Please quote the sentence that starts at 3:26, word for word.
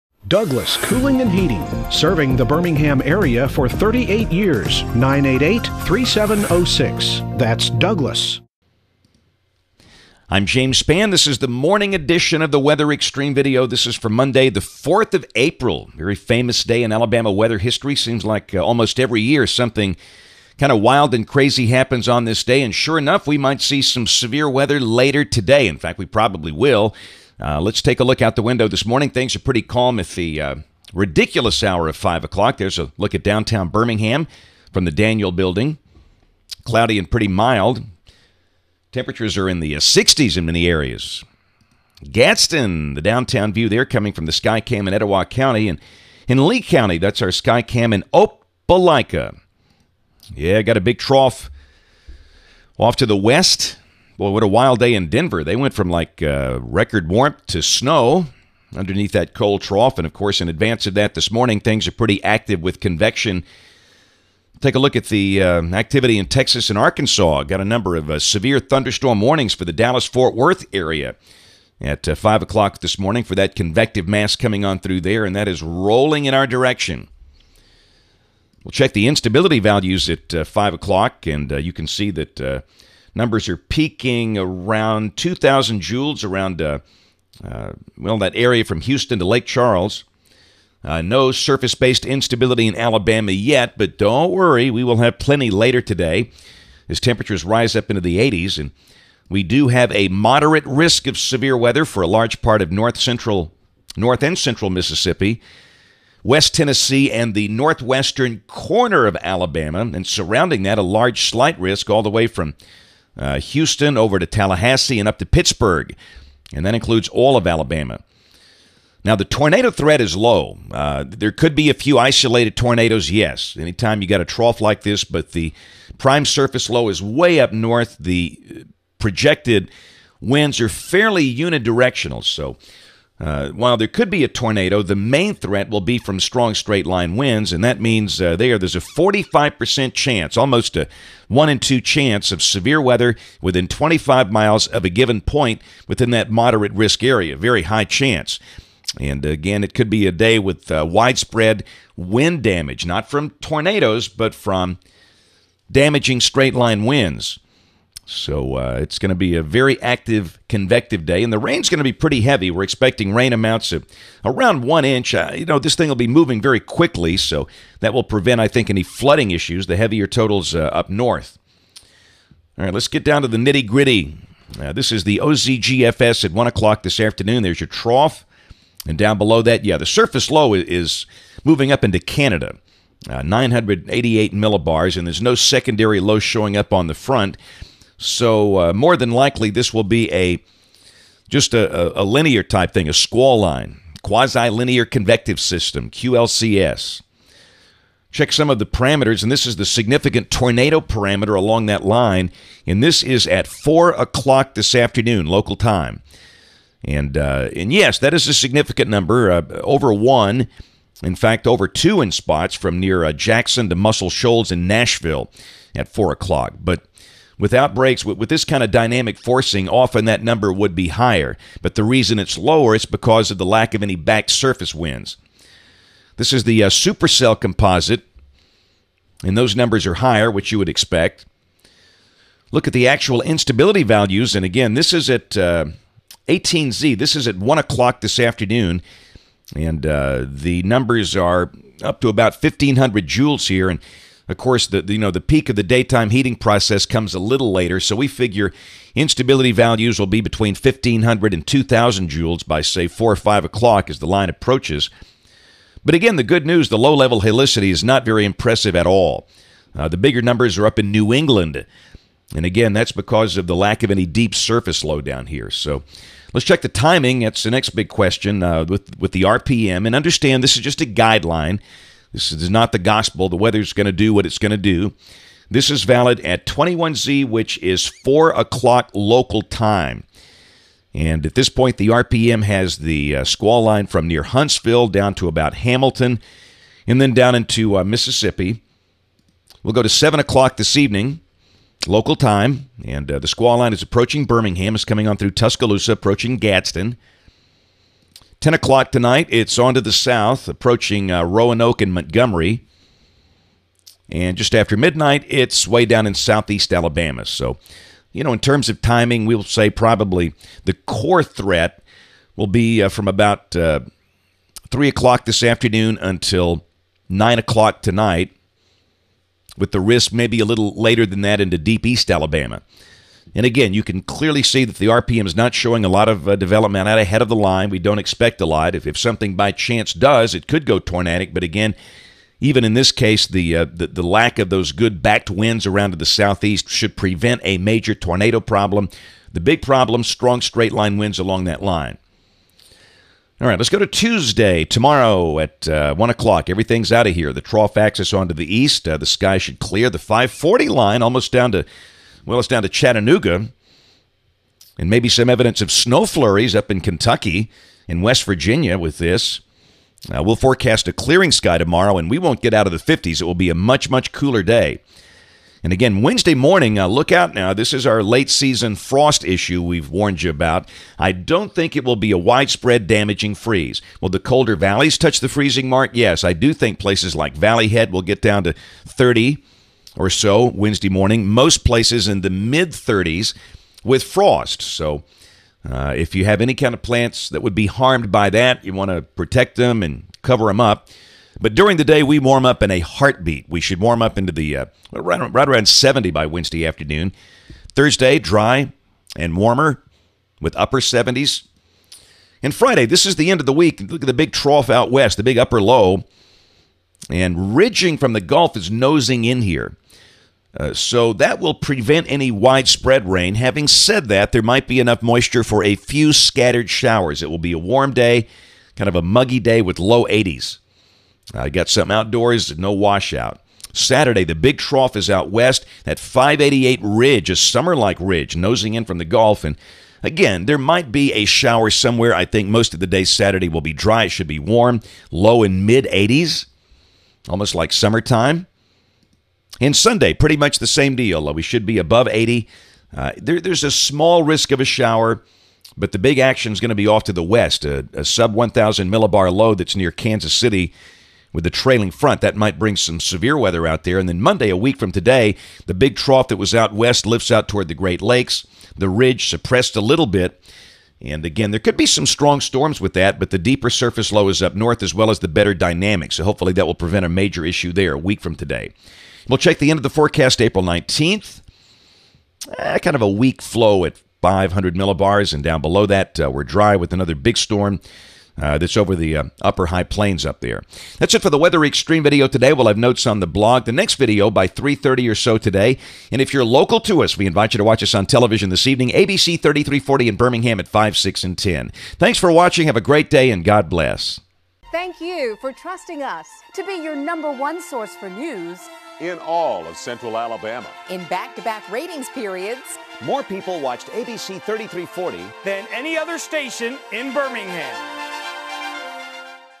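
And, uh, and yes, that is a significant number, uh, over 1.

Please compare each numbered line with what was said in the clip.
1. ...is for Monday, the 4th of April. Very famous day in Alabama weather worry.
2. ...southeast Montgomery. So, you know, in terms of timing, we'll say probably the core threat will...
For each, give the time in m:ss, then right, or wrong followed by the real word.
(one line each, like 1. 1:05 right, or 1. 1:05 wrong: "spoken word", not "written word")
1. 0:13 wrong: "history", not "worry"
2. 5:06 wrong: "Alabama", not "Montgomery".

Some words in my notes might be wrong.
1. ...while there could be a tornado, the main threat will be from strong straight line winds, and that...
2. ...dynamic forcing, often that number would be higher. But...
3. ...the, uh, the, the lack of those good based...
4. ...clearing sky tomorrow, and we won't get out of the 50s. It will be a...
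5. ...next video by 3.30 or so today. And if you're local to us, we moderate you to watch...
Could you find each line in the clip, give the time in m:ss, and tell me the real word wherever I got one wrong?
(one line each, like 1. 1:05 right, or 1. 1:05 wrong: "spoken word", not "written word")
1. 2:13 right
2. 3:38 right
3. 5:33 wrong: "backed", not "based"
4. 6:00 right
5. 8:03 wrong: "invite", not "moderate".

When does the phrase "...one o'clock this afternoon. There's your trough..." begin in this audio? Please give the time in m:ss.
2:56.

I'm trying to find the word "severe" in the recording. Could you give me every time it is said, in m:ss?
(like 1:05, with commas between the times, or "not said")
0:24, 1:08, 1:41, 2:22, 7:32.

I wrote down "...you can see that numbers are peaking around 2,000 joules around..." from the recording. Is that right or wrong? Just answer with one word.
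right.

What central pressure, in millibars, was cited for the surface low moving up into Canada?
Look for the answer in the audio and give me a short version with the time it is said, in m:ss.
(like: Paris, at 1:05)
988, at 3:03.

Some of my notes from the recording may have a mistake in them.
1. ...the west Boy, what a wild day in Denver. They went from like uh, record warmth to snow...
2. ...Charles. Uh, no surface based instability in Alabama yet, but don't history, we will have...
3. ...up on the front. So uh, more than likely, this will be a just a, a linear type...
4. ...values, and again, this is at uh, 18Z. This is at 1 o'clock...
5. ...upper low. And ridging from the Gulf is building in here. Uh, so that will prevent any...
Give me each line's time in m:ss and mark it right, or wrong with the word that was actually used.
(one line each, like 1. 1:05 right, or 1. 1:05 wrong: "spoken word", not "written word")
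1. 0:53 right
2. 1:29 wrong: "worry", not "history"
3. 3:06 right
4. 3:53 right
5. 6:45 wrong: "nosing", not "building".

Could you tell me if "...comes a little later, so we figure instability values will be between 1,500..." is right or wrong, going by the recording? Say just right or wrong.
right.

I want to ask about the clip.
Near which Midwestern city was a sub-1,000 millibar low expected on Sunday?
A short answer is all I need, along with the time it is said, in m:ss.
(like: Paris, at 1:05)
Kansas City, at 7:29.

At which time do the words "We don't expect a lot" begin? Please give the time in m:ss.
5:27.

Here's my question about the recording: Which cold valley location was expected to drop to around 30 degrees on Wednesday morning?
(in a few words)
Valley Head.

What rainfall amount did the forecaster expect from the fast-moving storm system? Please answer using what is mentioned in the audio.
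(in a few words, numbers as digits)
1 inch.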